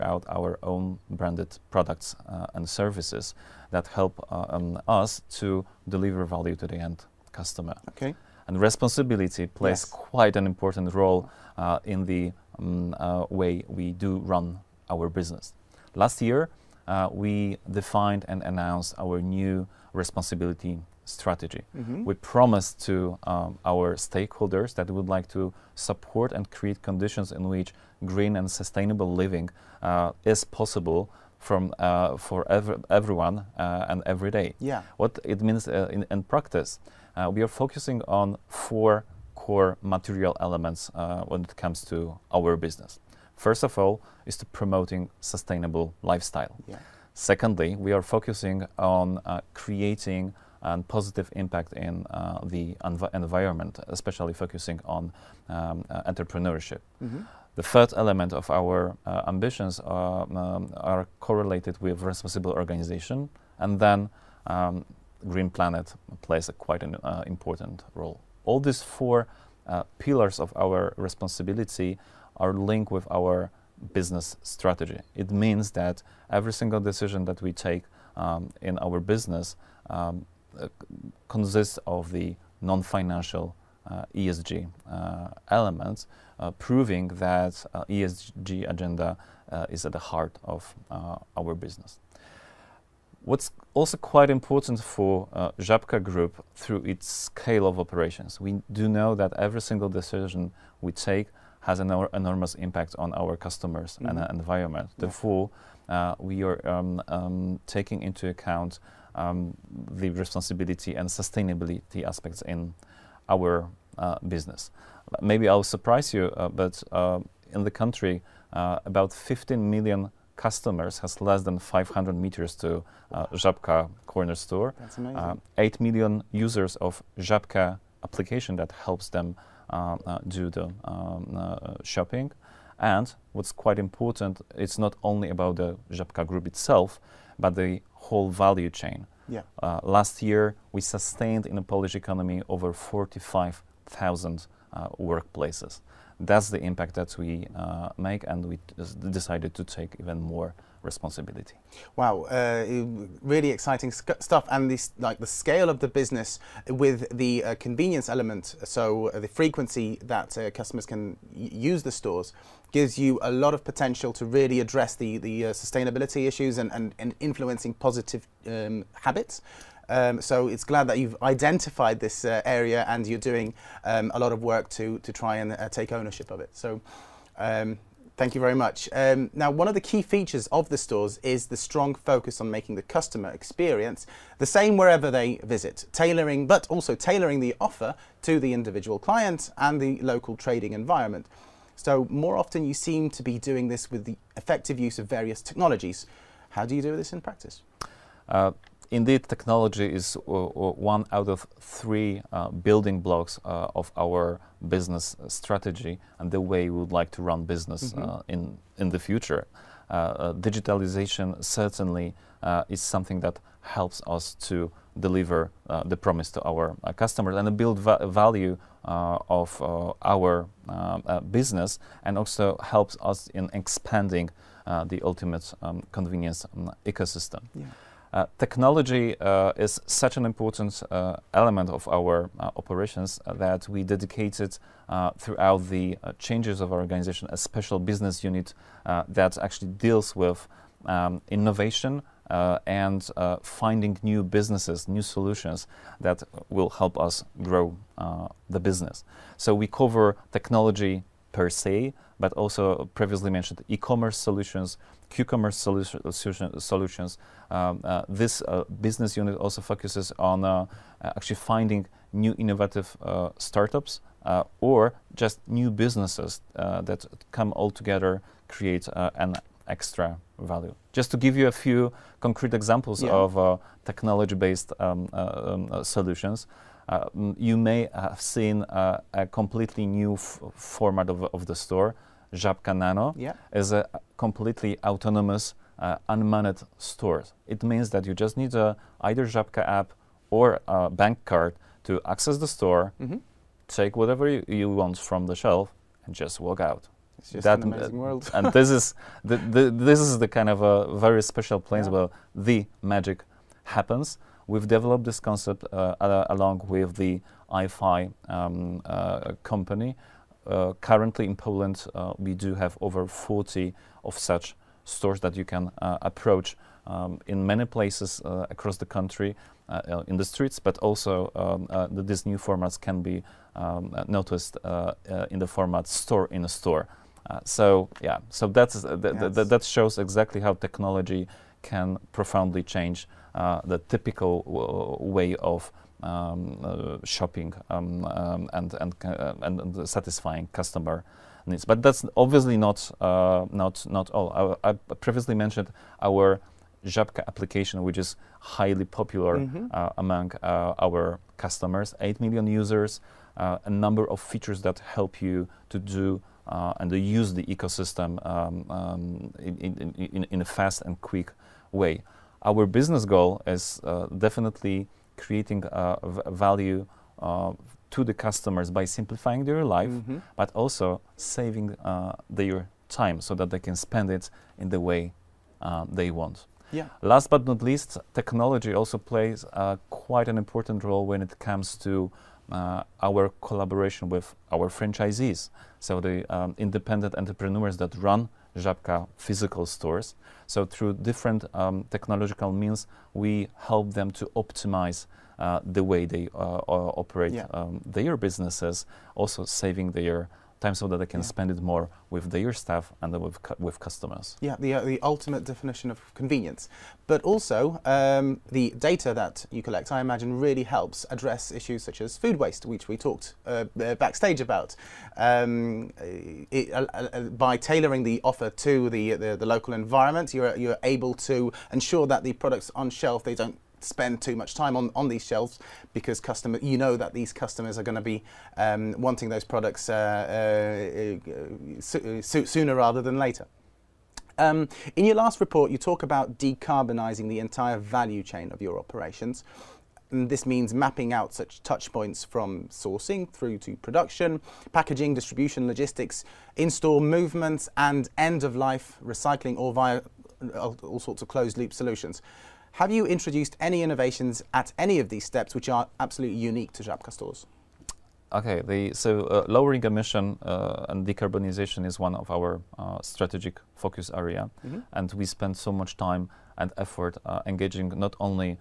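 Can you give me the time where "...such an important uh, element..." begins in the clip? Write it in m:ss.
3:49.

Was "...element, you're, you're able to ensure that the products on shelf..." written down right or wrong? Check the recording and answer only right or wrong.
wrong.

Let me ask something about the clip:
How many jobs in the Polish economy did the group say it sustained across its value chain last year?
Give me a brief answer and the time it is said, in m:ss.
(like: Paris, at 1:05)
over 45,000, at 2:22.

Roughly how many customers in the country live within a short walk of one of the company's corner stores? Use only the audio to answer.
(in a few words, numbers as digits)
15 million.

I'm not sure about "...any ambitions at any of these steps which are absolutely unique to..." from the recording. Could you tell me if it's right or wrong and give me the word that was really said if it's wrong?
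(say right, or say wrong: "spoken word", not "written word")
wrong: "innovations", not "ambitions".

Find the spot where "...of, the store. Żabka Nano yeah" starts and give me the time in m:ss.
4:41.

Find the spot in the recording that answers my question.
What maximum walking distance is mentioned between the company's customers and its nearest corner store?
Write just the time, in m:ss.
2:01.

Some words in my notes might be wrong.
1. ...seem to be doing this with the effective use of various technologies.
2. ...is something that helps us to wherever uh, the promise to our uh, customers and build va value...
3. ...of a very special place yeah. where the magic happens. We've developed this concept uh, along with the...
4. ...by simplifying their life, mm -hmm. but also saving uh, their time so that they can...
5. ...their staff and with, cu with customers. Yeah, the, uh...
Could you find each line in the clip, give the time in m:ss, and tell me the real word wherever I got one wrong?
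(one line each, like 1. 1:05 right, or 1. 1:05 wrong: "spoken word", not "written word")
1. 3:12 right
2. 3:32 wrong: "deliver", not "wherever"
3. 5:00 right
4. 6:08 right
5. 6:42 right.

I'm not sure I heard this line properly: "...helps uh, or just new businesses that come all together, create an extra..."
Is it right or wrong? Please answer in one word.
wrong.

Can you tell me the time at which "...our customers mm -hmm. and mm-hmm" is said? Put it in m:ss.
1:43.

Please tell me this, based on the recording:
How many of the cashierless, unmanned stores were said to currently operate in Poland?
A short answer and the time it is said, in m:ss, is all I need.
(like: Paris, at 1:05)
over 40, at 5:12.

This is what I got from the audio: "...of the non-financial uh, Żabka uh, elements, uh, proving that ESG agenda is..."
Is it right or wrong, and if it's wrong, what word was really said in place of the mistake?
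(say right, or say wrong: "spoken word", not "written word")
wrong: "ESG", not "Żabka".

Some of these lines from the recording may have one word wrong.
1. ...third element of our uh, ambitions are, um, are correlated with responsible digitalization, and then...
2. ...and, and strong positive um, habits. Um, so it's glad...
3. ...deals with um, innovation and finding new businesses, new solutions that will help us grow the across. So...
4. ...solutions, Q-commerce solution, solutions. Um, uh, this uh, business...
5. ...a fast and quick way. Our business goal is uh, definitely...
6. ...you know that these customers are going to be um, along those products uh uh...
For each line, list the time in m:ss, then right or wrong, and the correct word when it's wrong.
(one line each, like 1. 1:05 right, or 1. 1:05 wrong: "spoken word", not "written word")
1. 0:57 wrong: "organization", not "digitalization"
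2. 2:46 wrong: "influencing", not "strong"
3. 3:59 wrong: "business", not "across"
4. 4:14 right
5. 6:00 right
6. 7:06 wrong: "wanting", not "along".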